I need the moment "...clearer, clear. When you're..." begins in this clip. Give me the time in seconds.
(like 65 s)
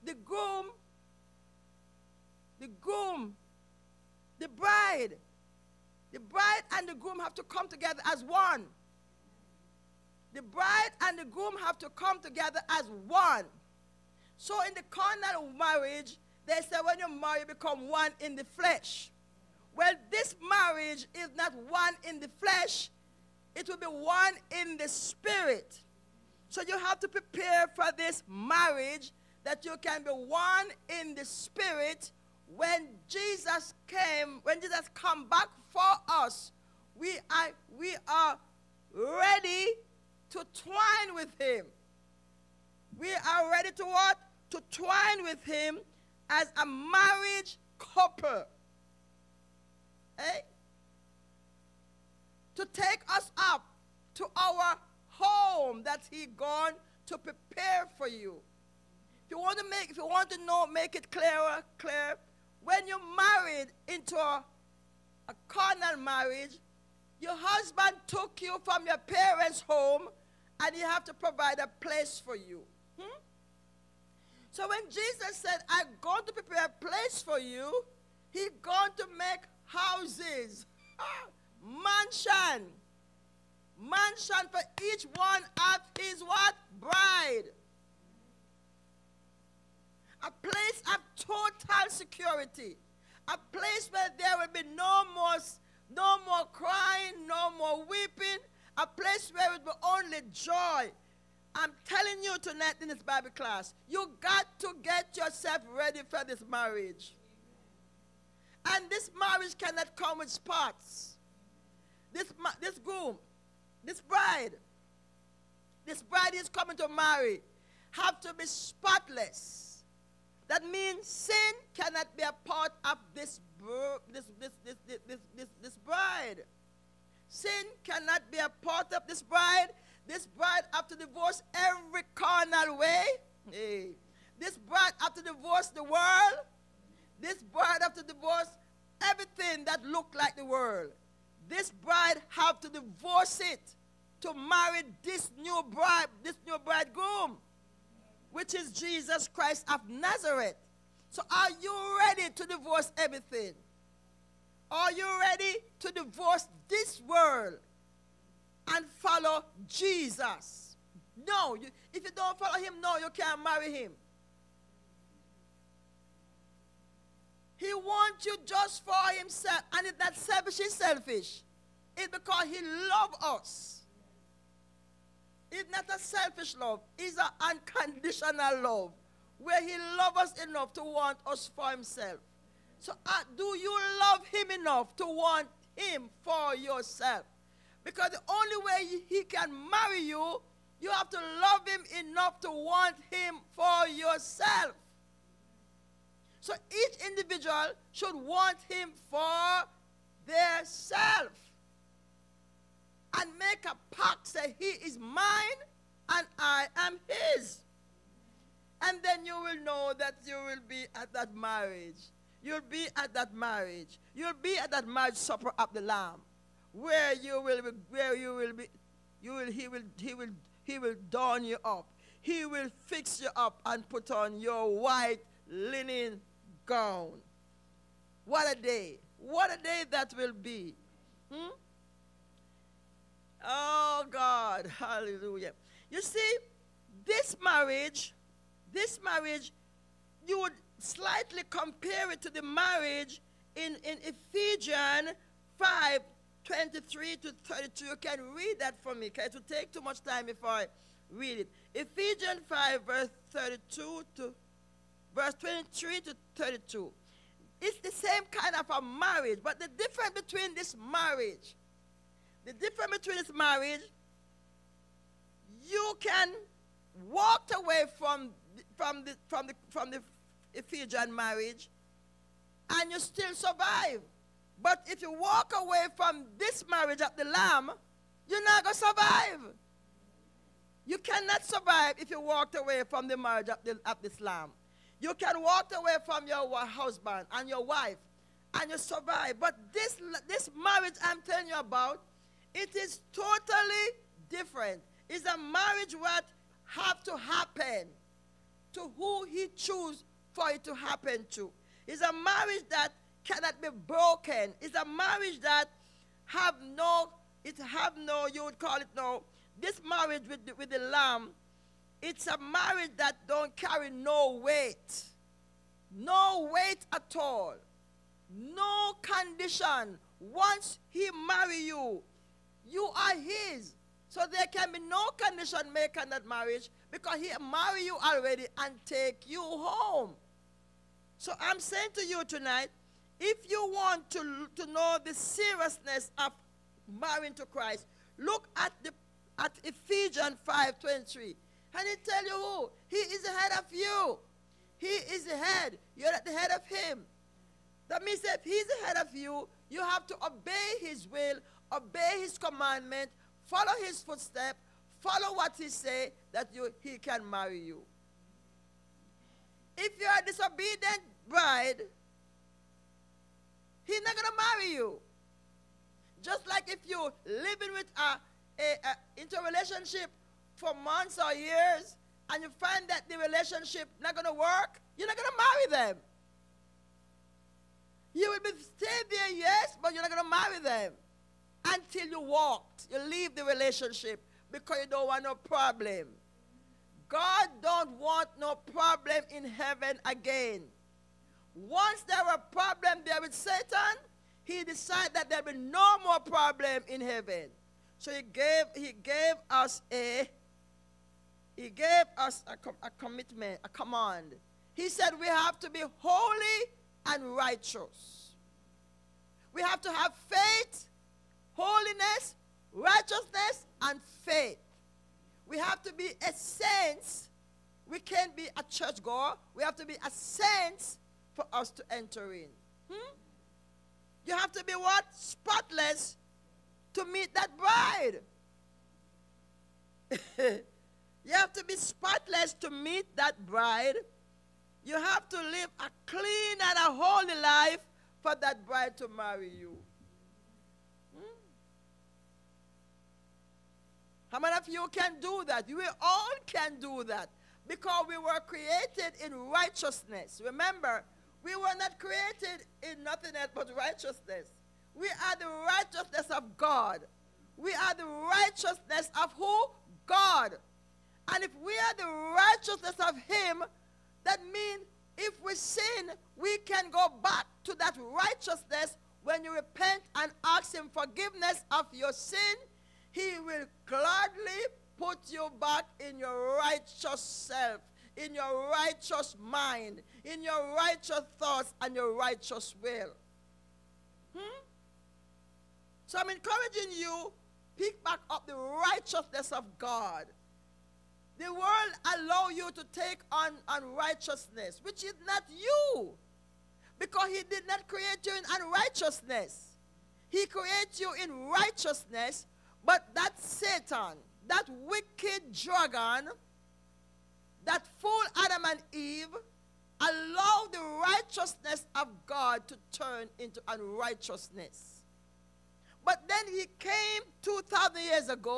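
61 s.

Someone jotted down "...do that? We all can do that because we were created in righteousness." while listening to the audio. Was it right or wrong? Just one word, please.
right.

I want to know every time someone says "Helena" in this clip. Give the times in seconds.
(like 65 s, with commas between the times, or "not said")
not said.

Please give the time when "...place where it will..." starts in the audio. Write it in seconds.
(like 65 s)
98 s.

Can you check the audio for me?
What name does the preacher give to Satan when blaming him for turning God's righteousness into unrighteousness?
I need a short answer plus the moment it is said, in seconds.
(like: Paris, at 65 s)
Wicked dragon, at 504 s.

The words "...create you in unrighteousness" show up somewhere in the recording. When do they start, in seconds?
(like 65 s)
497 s.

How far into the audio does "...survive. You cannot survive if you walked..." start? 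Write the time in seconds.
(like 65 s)
278 s.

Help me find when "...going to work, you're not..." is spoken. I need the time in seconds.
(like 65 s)
374 s.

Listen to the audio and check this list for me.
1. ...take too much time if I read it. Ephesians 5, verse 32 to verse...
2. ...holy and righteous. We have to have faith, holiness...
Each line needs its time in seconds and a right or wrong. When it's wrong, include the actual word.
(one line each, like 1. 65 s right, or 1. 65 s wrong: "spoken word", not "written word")
1. 249 s right
2. 405 s right.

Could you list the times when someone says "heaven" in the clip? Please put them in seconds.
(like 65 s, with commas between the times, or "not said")
389 s, 397 s.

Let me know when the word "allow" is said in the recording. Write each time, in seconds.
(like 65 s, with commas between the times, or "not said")
492 s, 509 s.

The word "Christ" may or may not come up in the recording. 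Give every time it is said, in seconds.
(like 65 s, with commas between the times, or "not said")
149 s, 337 s.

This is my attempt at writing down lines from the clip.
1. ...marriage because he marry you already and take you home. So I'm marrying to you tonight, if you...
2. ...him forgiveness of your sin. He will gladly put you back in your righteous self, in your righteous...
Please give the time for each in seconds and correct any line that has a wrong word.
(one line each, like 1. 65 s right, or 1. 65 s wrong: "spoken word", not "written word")
1. 326 s wrong: "saying", not "marrying"
2. 470 s right.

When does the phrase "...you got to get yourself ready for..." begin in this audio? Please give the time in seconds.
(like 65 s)
103 s.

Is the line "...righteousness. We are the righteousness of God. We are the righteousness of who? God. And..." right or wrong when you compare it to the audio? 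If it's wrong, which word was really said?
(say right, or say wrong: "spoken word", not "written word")
right.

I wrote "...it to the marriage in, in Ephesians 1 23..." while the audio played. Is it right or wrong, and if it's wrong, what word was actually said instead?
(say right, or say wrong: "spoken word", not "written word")
wrong: "5", not "1".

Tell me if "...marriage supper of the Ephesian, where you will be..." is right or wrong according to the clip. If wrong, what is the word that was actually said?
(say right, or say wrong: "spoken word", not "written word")
wrong: "Lamb", not "Ephesian".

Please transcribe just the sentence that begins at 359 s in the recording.
If you're a disobedient bride, he's not going to marry you.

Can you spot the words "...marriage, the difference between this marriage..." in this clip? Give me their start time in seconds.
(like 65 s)
260 s.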